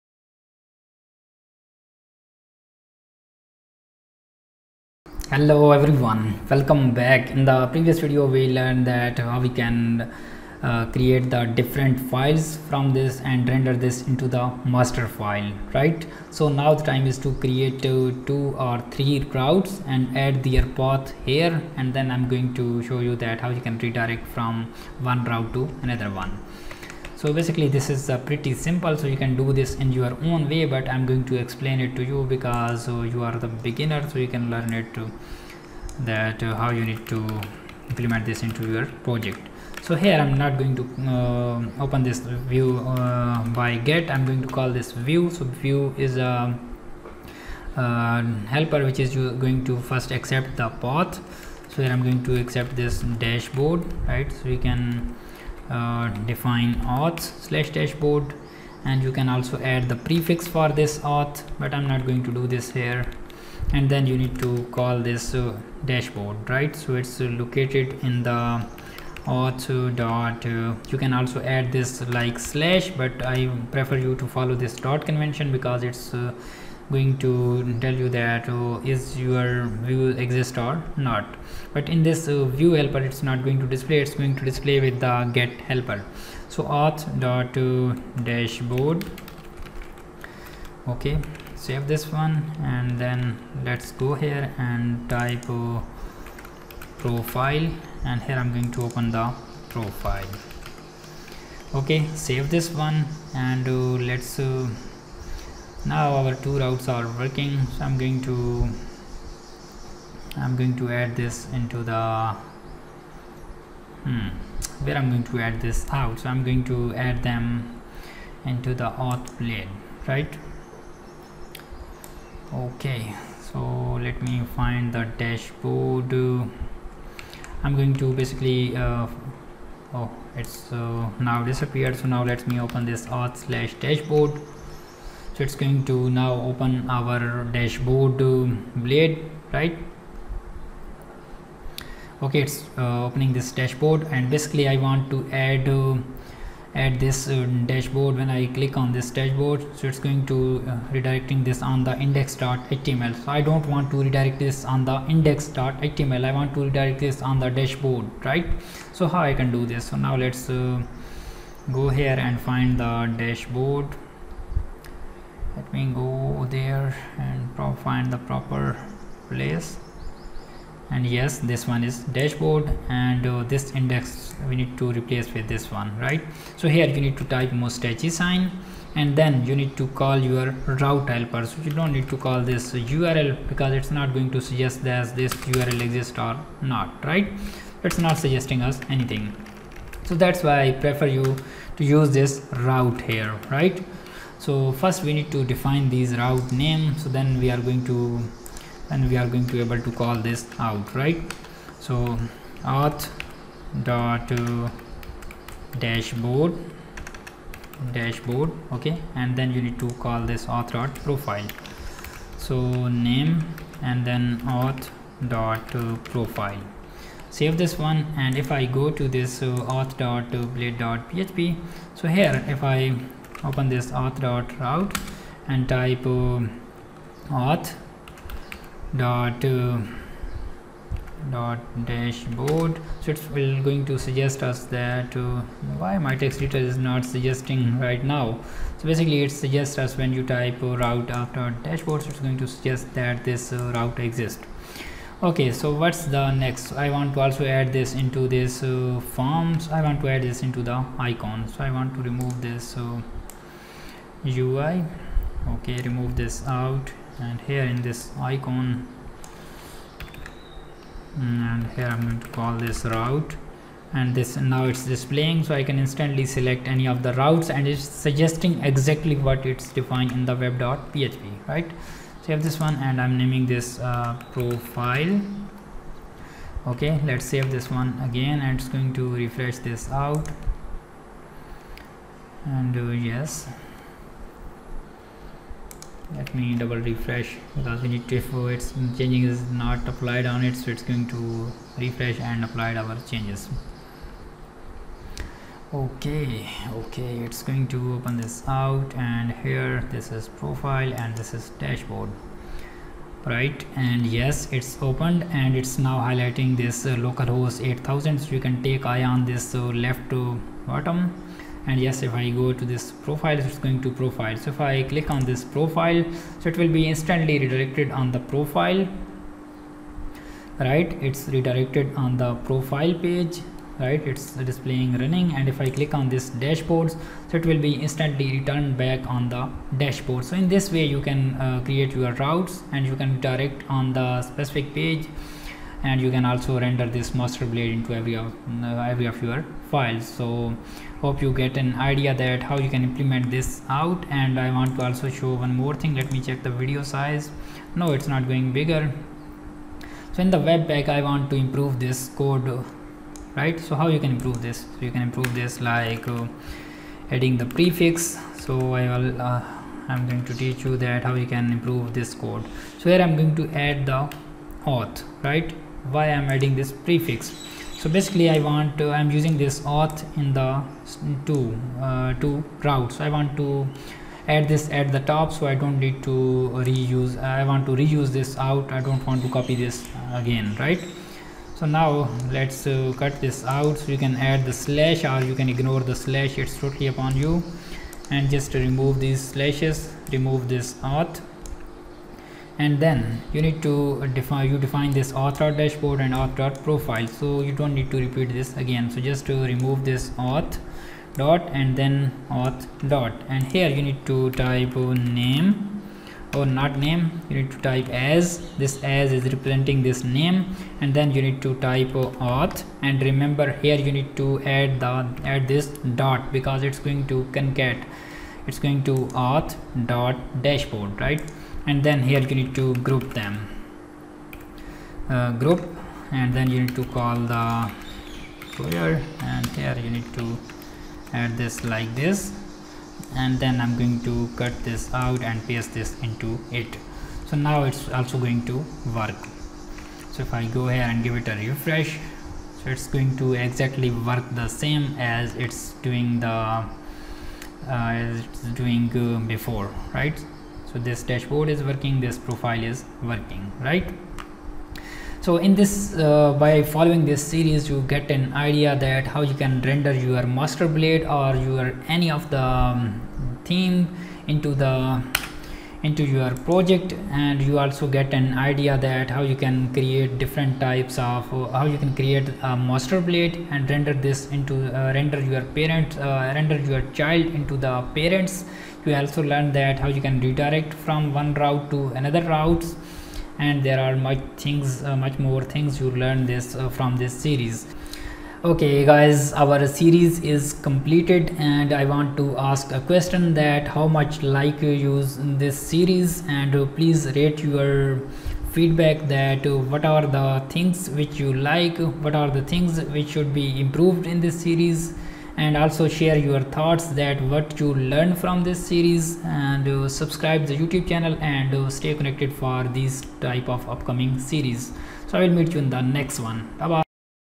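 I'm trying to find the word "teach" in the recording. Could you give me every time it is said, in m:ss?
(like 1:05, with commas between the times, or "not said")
6:00.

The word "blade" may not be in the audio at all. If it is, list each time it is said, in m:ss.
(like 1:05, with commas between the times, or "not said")
1:59, 2:18, 3:40, 5:37, 7:40, 7:53.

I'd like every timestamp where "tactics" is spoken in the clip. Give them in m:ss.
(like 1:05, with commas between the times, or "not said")
not said.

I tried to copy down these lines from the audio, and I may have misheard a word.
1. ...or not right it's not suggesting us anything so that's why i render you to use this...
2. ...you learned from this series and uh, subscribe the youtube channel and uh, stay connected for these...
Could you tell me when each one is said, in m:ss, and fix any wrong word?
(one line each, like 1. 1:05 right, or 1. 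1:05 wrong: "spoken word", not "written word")
1. 3:06 wrong: "prefer", not "render"
2. 8:27 right.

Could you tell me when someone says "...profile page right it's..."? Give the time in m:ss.
5:22.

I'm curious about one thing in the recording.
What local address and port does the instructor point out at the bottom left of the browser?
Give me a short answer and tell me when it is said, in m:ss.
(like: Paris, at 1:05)
localhost 8000, at 5:06.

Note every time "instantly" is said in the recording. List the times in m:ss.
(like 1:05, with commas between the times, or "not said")
4:25, 5:16, 5:27.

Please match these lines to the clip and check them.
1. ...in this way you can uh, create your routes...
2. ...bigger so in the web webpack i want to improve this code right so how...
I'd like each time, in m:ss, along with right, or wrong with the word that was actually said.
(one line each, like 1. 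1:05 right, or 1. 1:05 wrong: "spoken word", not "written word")
1. 5:30 right
2. 5:48 right.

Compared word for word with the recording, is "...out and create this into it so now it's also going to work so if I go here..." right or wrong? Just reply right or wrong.
wrong.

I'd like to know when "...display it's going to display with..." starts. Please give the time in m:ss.
1:23.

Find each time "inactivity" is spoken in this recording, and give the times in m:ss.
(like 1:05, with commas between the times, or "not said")
not said.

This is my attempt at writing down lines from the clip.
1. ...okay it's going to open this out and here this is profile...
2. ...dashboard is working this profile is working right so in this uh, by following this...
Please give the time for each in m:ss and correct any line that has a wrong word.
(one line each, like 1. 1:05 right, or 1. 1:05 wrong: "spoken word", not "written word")
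1. 4:56 right
2. 7:31 right.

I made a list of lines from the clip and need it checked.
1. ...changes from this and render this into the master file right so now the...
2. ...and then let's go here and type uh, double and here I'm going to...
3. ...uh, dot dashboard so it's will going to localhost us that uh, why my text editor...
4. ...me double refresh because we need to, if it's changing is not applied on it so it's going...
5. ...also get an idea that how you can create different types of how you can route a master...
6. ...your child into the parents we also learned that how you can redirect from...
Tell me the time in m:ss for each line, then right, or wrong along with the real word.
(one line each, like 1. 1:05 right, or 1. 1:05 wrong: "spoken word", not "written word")
1. 0:12 wrong: "files", not "changes"
2. 1:32 wrong: "profile", not "double"
3. 3:49 wrong: "suggest", not "localhost"
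4. 4:46 right
5. 7:47 wrong: "create", not "route"
6. 7:56 right.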